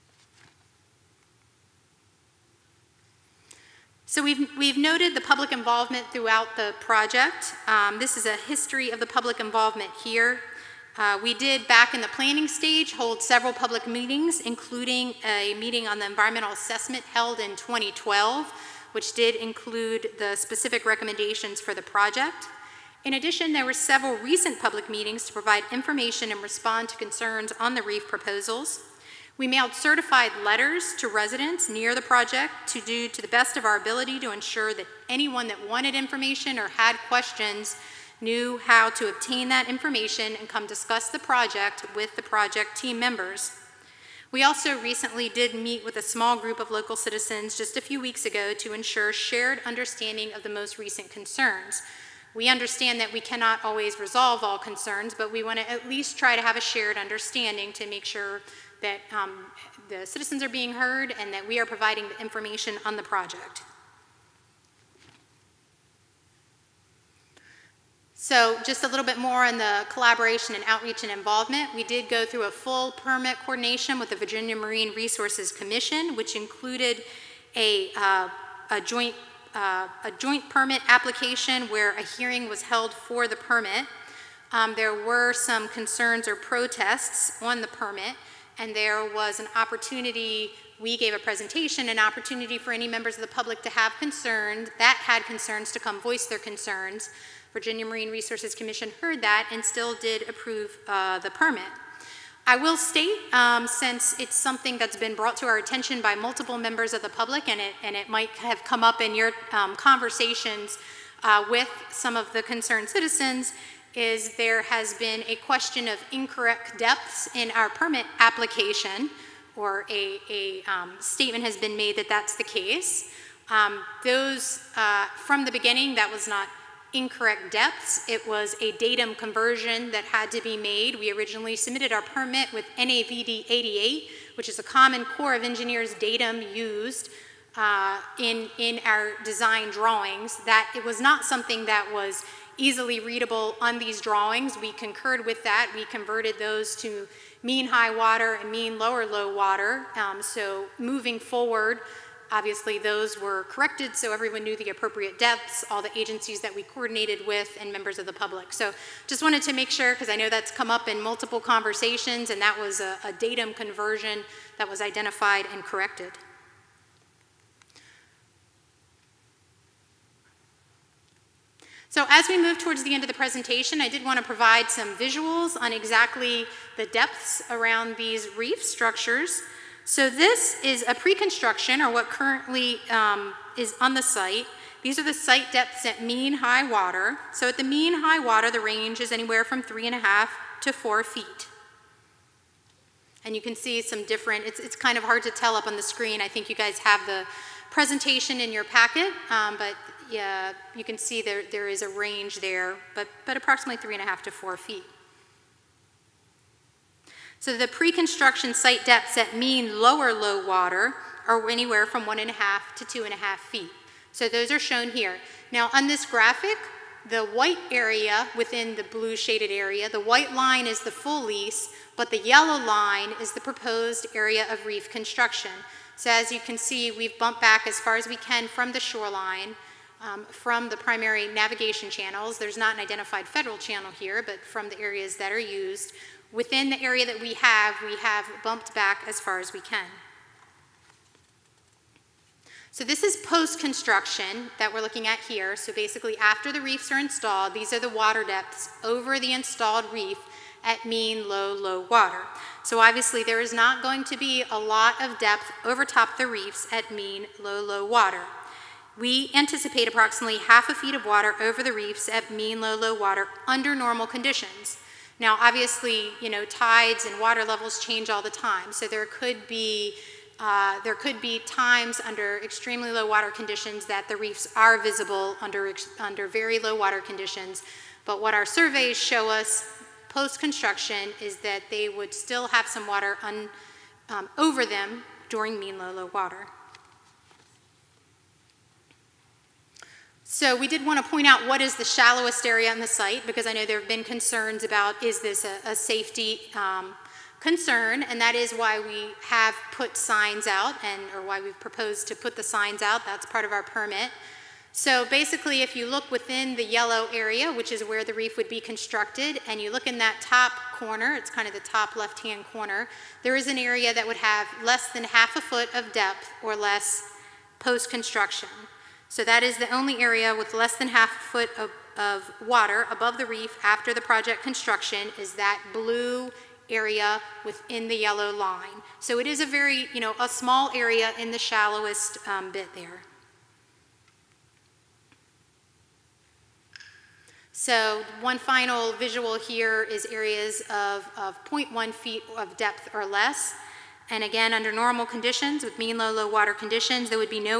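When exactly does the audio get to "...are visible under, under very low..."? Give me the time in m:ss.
4:34.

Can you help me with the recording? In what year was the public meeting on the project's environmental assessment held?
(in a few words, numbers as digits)
2012.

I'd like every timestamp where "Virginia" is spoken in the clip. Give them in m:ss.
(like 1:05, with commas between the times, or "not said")
1:14, 1:37.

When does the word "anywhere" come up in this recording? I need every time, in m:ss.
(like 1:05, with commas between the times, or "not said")
3:09, 3:31.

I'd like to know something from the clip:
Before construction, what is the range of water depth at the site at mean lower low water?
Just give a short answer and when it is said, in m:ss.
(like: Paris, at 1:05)
1.5 to 2.5 feet, at 3:32.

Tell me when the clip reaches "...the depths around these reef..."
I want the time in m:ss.
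2:56.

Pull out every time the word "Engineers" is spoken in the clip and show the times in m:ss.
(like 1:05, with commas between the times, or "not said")
2:15.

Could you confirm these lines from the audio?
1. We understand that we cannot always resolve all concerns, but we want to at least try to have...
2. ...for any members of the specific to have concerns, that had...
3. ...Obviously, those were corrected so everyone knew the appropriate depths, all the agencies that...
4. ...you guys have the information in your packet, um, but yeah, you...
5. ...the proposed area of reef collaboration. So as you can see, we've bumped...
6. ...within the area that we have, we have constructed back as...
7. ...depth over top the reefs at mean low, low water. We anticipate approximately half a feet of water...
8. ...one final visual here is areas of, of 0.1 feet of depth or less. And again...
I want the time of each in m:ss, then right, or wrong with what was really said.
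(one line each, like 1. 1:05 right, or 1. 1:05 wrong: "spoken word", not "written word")
1. 0:52 right
2. 1:32 wrong: "public", not "specific"
3. 2:32 right
4. 3:16 wrong: "presentation", not "information"
5. 3:43 wrong: "construction", not "collaboration"
6. 3:56 wrong: "bumped", not "constructed"
7. 4:15 right
8. 5:38 right.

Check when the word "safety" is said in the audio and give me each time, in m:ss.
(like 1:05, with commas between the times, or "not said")
4:55.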